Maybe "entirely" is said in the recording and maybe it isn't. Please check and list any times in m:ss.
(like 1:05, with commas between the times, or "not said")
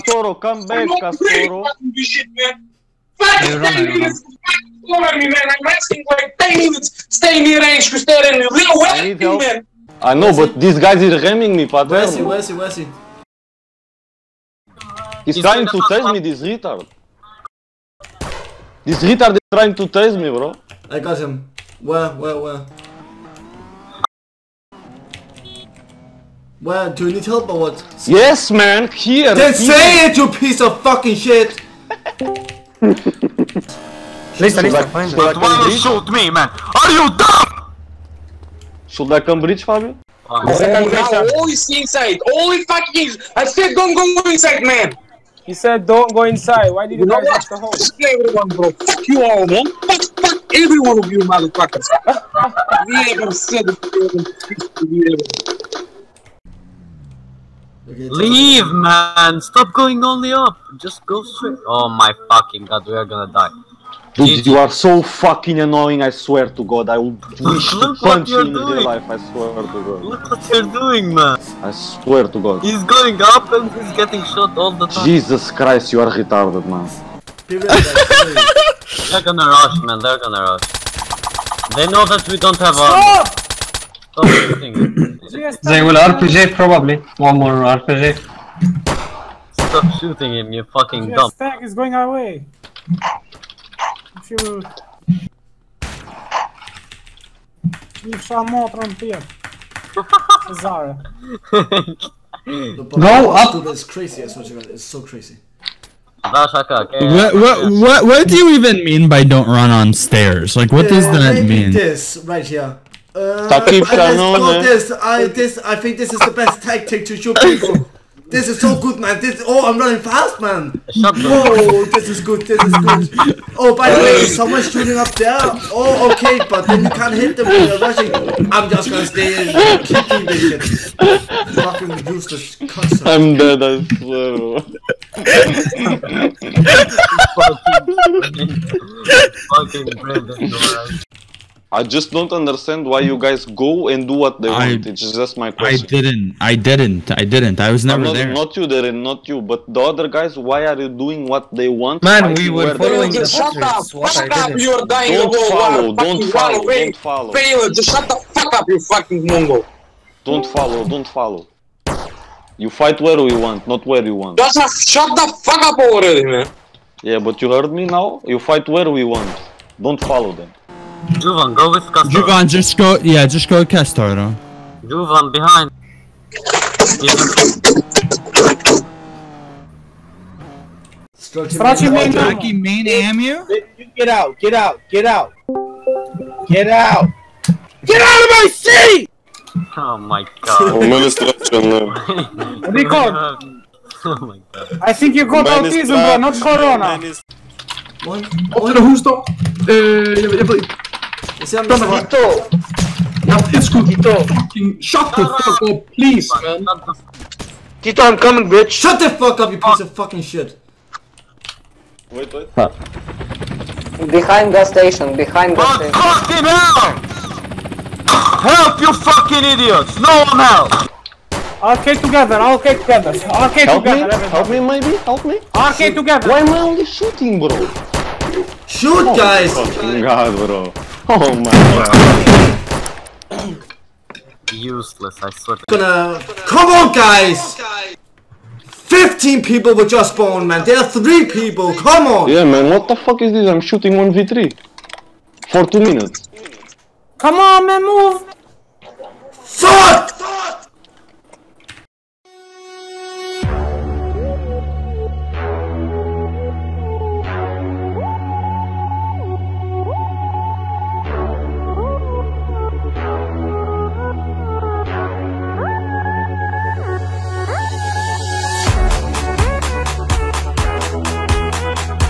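not said.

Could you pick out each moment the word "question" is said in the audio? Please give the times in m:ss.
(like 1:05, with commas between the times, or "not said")
2:25.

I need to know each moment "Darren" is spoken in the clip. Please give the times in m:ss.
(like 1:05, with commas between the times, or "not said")
2:28.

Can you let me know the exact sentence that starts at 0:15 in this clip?
He's, trying to chase me, this retard.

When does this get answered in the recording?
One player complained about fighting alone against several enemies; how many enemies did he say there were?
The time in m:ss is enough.
4:00.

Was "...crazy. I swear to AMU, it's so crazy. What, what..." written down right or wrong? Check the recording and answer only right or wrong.
wrong.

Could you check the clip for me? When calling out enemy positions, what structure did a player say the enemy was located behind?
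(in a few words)
the station.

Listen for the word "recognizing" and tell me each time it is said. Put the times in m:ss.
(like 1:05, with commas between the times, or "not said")
not said.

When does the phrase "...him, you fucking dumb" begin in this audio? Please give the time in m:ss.
1:30.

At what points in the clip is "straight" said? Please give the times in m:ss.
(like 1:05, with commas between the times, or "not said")
1:01.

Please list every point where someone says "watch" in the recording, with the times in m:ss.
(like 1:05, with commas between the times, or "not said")
0:47.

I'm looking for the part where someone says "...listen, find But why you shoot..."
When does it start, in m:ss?
0:34.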